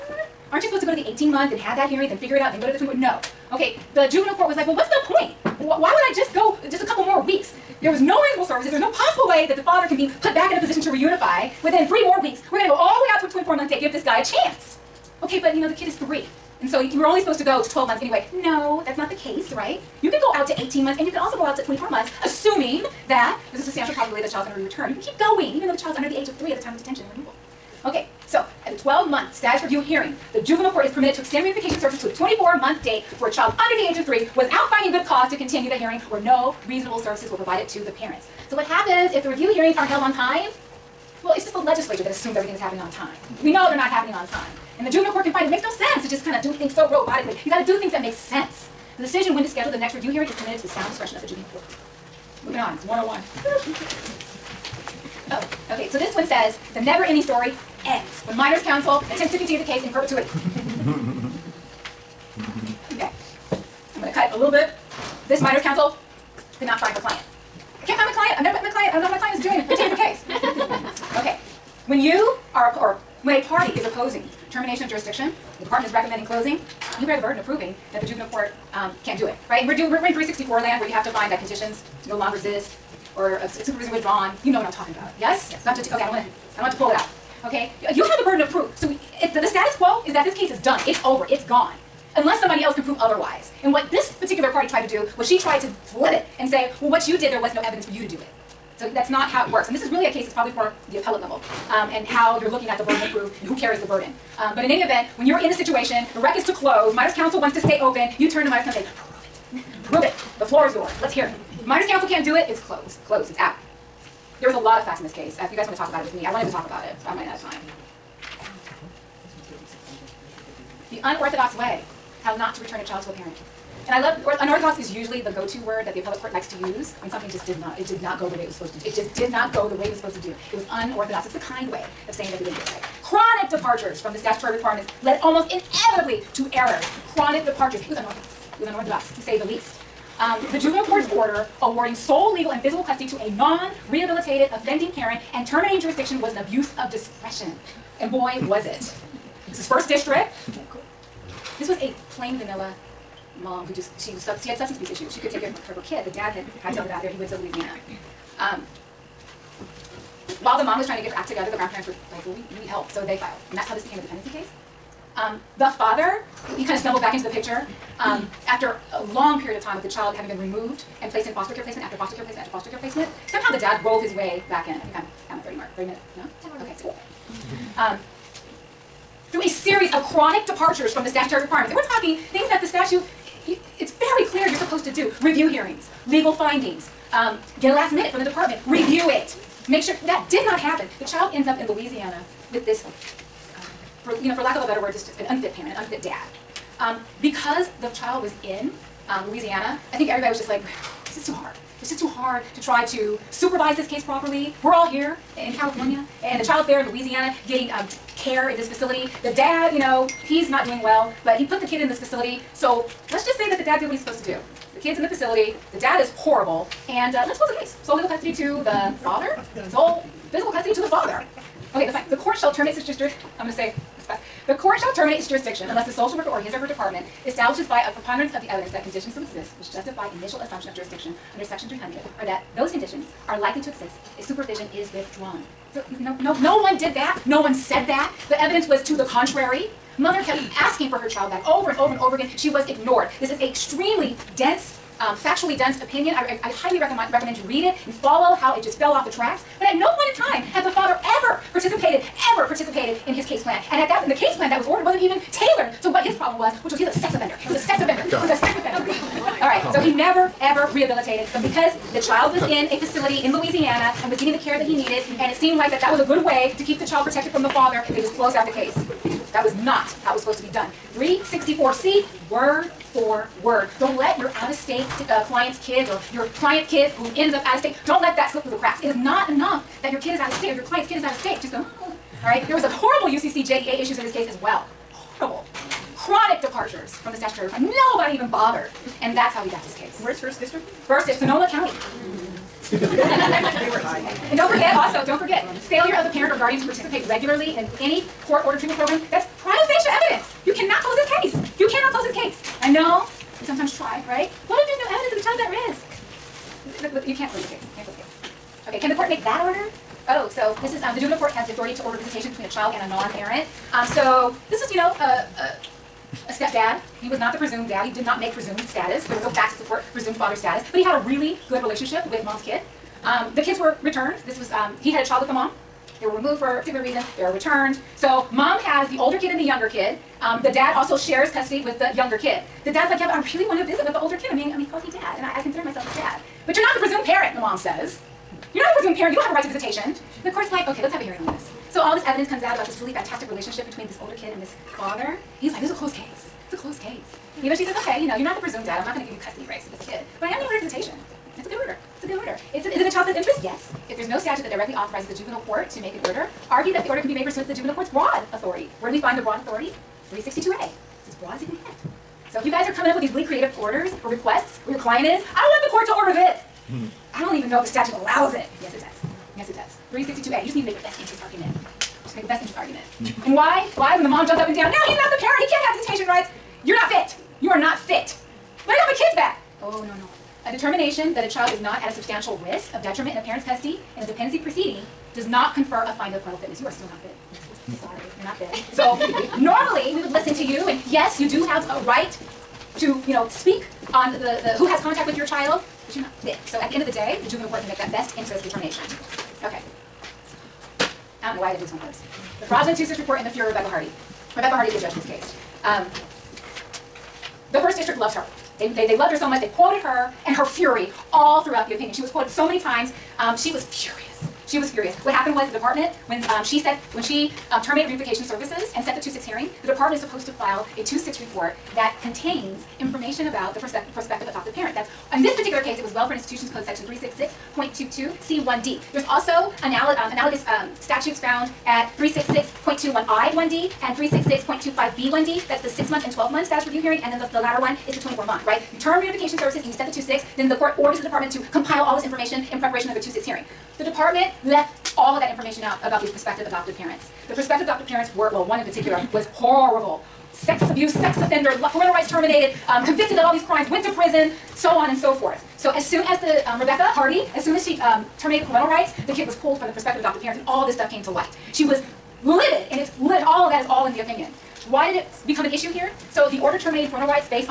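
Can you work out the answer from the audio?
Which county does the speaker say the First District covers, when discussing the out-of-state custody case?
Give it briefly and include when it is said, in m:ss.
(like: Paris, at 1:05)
Sonoma County, at 4:51.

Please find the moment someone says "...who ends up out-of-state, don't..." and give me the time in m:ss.
4:36.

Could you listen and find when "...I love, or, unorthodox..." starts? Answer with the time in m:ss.
2:03.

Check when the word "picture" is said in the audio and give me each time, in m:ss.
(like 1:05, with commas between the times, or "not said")
2:47.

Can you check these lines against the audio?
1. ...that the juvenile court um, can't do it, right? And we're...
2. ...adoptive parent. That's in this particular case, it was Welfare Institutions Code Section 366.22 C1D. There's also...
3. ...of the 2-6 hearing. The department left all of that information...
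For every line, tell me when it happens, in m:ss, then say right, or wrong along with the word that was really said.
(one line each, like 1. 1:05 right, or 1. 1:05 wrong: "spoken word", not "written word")
1. 1:17 right
2. 7:04 right
3. 7:22 right.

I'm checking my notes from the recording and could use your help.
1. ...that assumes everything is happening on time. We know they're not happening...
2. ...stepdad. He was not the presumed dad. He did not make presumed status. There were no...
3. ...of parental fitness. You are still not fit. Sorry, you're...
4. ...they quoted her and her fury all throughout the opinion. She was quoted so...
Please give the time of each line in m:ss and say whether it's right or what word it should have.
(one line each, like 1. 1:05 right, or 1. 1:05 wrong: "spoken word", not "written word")
1. 0:42 right
2. 5:16 right
3. 6:26 right
4. 6:49 right.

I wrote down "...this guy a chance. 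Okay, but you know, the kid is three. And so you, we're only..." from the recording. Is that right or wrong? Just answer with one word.
right.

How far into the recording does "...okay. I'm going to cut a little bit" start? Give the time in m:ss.
1:02.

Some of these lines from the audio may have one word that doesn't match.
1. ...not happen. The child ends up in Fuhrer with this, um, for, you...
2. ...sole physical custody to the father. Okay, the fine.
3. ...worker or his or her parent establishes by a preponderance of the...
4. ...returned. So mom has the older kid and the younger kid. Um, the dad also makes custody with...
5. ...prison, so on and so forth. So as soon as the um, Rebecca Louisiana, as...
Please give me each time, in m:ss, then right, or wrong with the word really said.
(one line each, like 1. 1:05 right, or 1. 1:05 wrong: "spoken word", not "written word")
1. 3:10 wrong: "Louisiana", not "Fuhrer"
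2. 3:39 right
3. 3:46 wrong: "department", not "parent"
4. 5:27 wrong: "shares", not "makes"
5. 7:33 wrong: "Hardy", not "Louisiana".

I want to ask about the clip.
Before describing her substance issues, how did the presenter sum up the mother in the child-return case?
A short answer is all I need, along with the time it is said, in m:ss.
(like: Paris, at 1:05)
plain vanilla, at 2:32.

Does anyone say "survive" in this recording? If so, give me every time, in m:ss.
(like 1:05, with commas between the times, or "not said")
not said.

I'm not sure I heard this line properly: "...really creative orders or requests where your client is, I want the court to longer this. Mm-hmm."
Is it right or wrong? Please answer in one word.
wrong.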